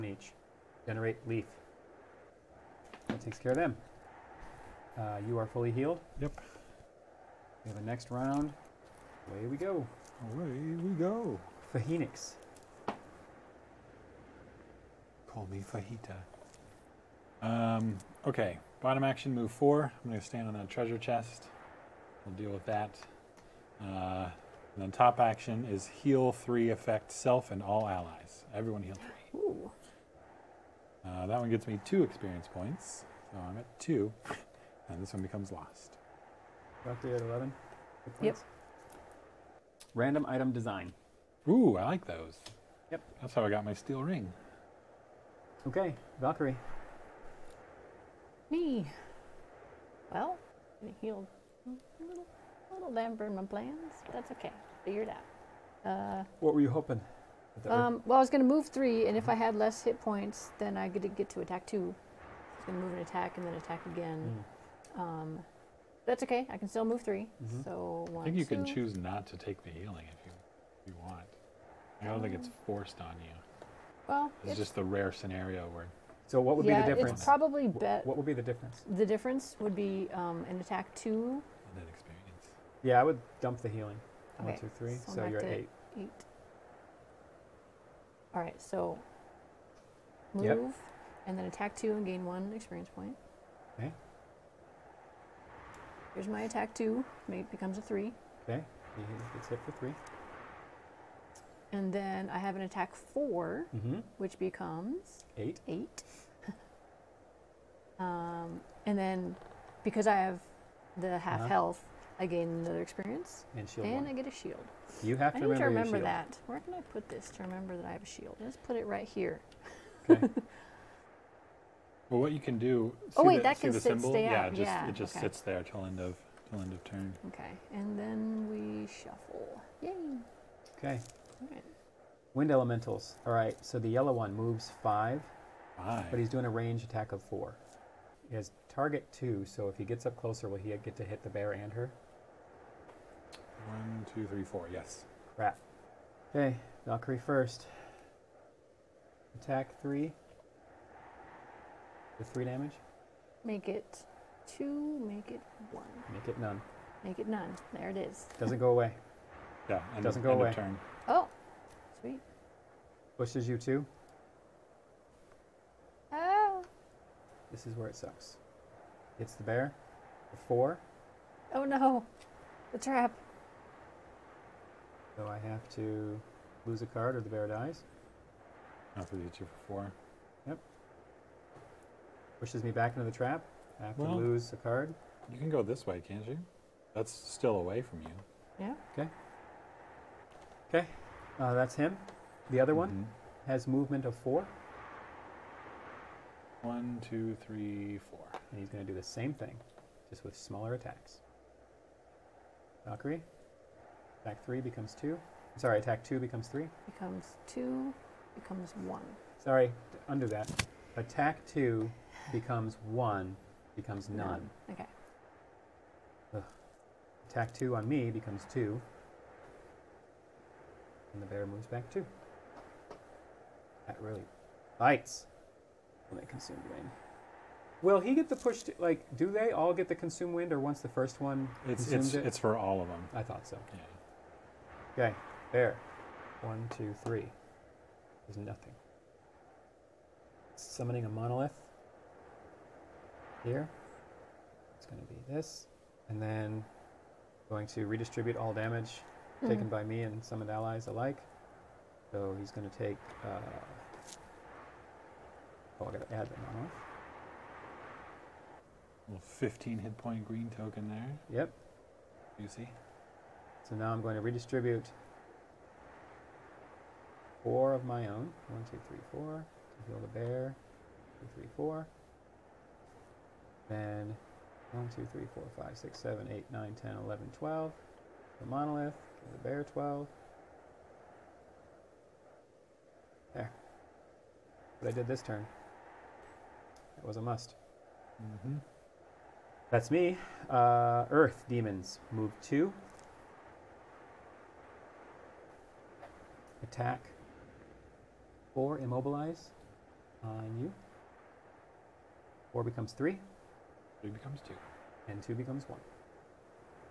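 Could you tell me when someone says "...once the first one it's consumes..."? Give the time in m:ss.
3:50.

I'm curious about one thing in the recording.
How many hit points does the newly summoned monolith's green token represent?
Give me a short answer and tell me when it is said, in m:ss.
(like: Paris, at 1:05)
15, at 4:19.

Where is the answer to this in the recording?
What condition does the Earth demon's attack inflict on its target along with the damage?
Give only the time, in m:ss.
4:58.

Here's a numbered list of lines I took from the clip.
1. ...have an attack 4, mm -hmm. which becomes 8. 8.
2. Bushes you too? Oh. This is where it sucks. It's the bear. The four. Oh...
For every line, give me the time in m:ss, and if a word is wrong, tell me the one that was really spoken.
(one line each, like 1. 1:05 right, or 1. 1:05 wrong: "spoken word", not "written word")
1. 1:42 right
2. 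2:43 right.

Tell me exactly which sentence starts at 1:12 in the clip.
I don't um, think it's forced on you.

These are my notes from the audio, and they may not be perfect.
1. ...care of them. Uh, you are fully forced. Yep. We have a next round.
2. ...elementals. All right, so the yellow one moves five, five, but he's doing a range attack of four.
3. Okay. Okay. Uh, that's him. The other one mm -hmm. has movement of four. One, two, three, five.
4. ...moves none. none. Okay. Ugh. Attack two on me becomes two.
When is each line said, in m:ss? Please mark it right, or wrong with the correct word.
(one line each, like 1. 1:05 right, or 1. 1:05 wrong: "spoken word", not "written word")
1. 0:03 wrong: "healed", not "forced"
2. 2:12 right
3. 3:08 wrong: "four", not "five"
4. 3:33 wrong: "becomes", not "moves".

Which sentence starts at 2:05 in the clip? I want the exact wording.
sits there till end of till end of turn.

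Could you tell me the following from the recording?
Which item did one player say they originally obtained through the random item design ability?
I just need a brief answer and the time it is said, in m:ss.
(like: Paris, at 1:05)
steel ring, at 0:43.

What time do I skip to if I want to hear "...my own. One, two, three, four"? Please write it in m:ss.
4:27.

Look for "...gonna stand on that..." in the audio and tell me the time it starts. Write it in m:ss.
0:20.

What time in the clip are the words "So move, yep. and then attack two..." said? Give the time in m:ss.
1:28.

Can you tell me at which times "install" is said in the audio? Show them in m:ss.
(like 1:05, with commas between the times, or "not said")
not said.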